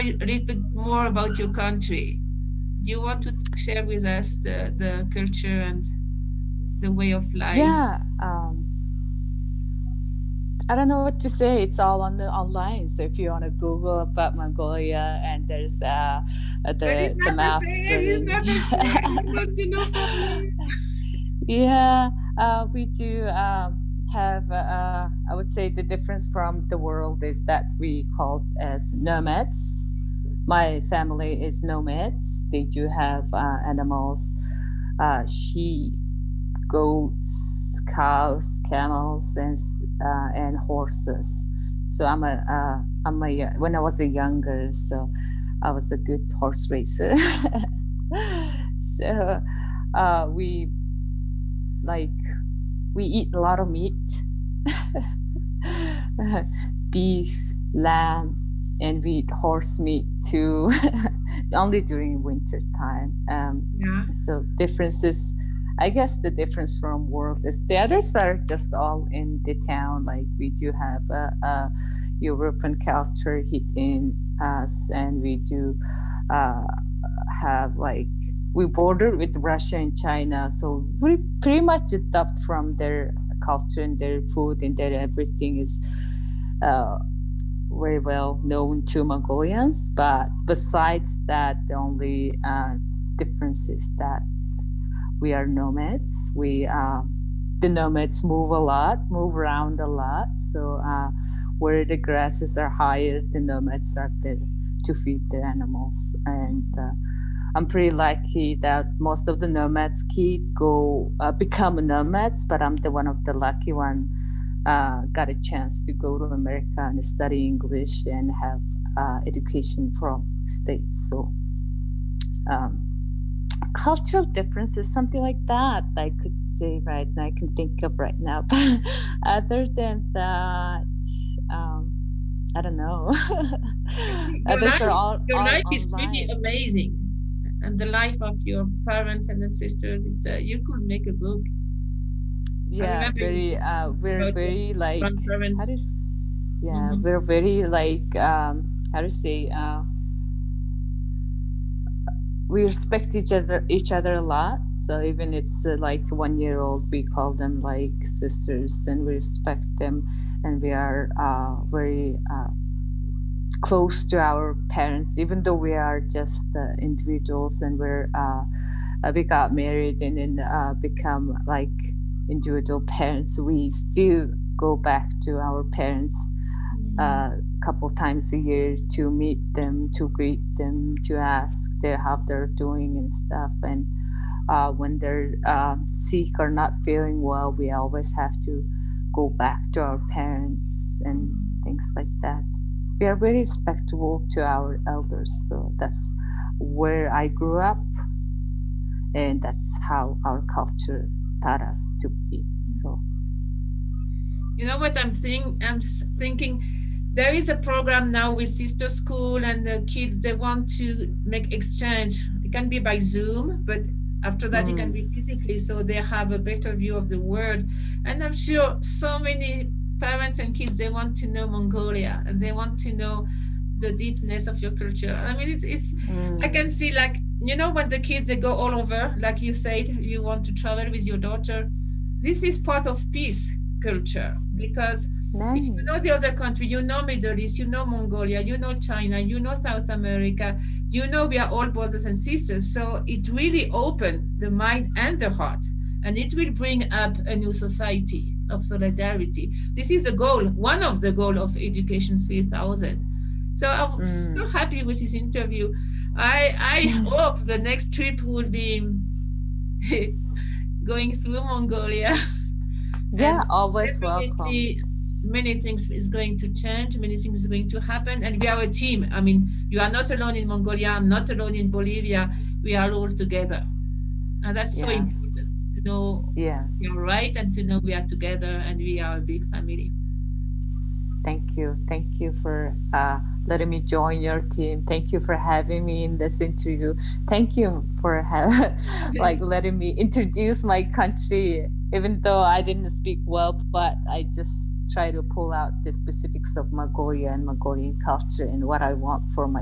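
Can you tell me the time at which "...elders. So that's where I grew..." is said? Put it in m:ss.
3:14.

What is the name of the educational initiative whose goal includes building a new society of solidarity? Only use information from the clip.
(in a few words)
Education 3000.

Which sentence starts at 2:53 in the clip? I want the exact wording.
We still go back to our parents a mm.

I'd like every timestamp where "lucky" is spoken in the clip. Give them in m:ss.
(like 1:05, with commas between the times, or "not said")
1:47, 1:53.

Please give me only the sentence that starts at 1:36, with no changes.
We um, the nomads move a lot, move around a lot.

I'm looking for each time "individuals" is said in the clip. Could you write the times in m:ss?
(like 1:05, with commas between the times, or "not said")
2:46, 2:52.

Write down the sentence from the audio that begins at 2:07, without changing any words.
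I can think of right now.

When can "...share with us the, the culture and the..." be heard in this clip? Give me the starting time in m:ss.
0:03.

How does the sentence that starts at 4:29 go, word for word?
I mean, you are not alone in Mongolia, I'm not alone in Bolivia.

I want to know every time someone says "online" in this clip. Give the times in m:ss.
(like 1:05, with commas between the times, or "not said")
0:12, 2:15.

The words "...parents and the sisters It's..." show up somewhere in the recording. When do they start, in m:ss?
2:18.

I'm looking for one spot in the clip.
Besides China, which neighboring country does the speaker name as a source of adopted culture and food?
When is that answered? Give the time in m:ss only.
1:19.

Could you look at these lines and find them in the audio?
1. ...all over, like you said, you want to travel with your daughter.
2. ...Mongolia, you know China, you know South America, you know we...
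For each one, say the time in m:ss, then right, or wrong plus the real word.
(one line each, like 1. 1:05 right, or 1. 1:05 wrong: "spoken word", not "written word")
1. 3:48 right
2. 3:57 right.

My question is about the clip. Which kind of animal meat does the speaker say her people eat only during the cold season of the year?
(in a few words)
Horse meat.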